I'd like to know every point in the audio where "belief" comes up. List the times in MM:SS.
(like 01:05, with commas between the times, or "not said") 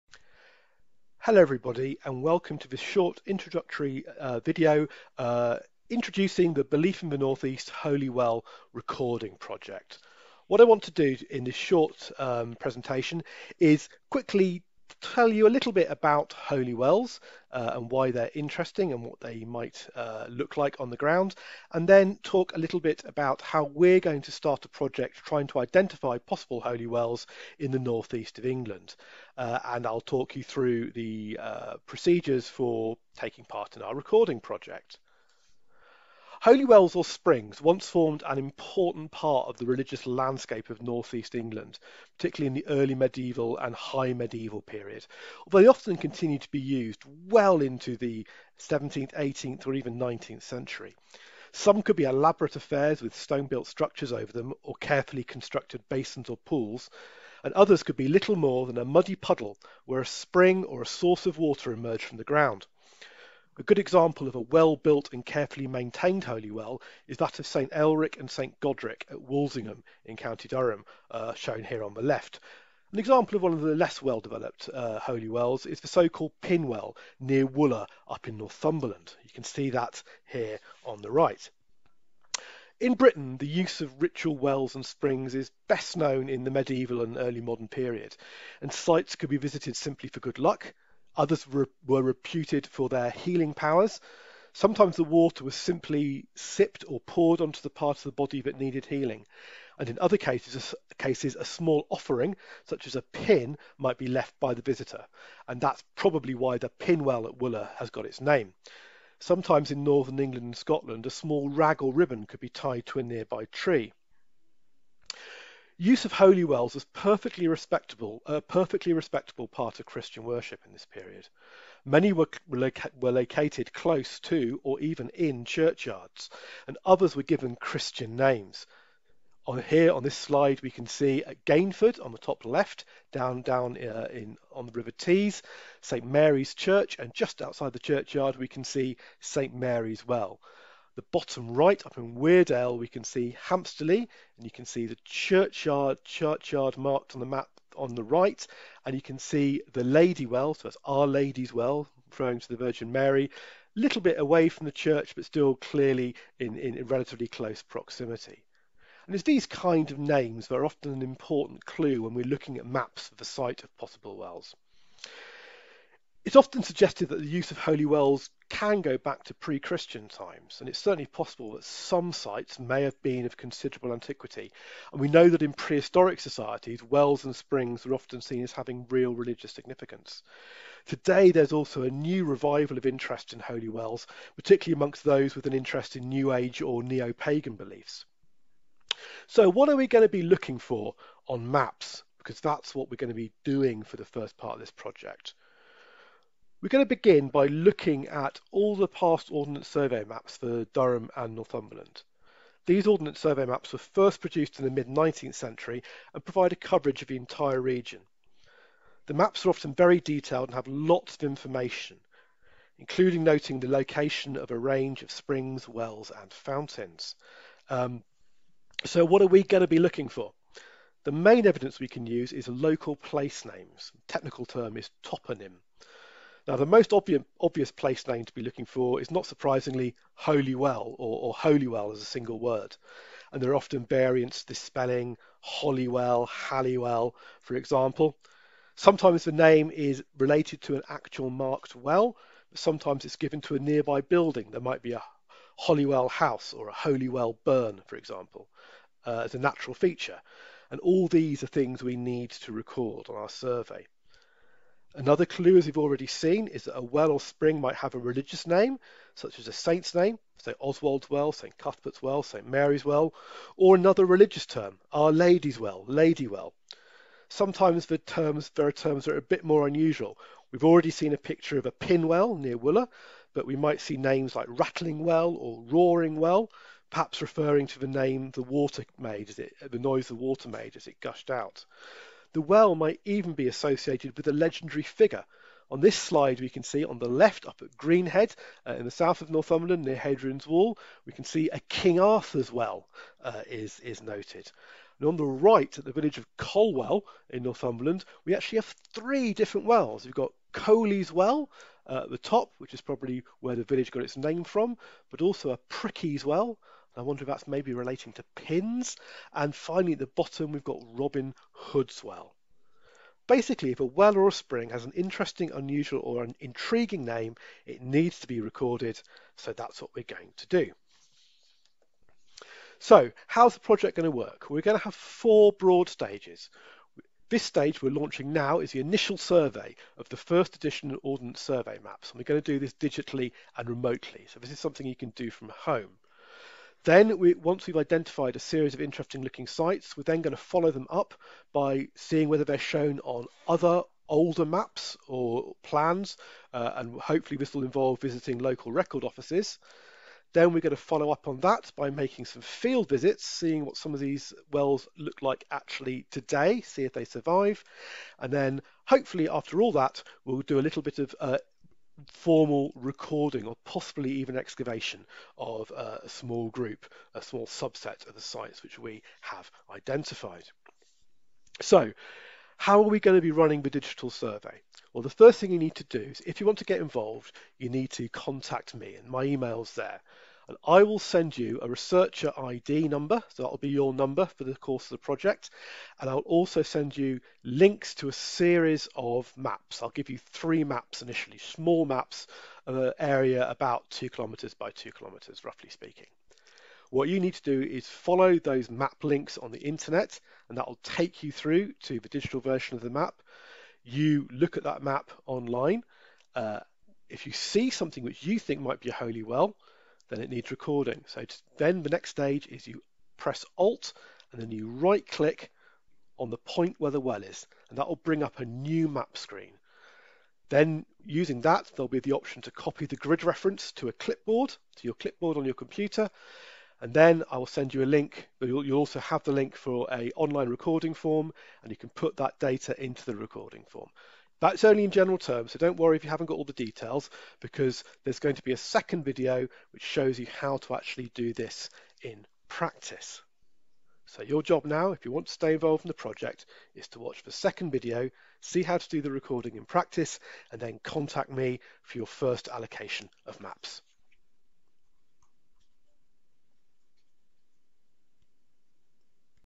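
00:06, 03:07.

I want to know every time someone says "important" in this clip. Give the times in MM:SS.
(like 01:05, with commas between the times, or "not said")
00:38, 02:41.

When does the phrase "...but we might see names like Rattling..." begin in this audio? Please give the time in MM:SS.
04:33.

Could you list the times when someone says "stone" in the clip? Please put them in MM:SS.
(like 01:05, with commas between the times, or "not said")
00:53.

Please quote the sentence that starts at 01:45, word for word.
And that's probably why the pin well at Wooler has got its name.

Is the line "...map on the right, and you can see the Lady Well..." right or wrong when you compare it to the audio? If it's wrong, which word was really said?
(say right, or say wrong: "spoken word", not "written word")
right.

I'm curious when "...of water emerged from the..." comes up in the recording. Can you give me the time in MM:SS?
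01:01.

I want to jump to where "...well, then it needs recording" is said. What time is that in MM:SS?
06:49.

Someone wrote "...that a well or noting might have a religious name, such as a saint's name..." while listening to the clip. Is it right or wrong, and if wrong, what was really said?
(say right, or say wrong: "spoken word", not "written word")
wrong: "spring", not "noting".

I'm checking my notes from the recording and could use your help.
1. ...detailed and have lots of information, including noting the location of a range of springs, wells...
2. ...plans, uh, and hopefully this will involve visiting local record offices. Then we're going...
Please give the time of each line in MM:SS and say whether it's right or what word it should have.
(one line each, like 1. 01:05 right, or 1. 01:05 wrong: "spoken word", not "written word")
1. 03:30 right
2. 05:45 right.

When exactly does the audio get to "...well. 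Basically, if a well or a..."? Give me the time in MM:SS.
05:12.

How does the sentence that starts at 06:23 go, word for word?
So that'll be your number for the course of the project.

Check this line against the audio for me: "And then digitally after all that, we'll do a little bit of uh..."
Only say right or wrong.
wrong.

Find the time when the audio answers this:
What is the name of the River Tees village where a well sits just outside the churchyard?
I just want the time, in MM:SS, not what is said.
02:11.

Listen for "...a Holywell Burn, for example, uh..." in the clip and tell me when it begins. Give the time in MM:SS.
04:06.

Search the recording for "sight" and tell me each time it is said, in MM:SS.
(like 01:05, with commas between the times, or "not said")
not said.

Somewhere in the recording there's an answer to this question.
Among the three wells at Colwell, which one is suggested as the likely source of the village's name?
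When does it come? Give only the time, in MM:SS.
05:00.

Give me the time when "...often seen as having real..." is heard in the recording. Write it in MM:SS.
02:57.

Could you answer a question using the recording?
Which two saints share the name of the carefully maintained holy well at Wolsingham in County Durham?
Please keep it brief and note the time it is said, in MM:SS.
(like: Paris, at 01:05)
St Elric and St Godric, at 01:07.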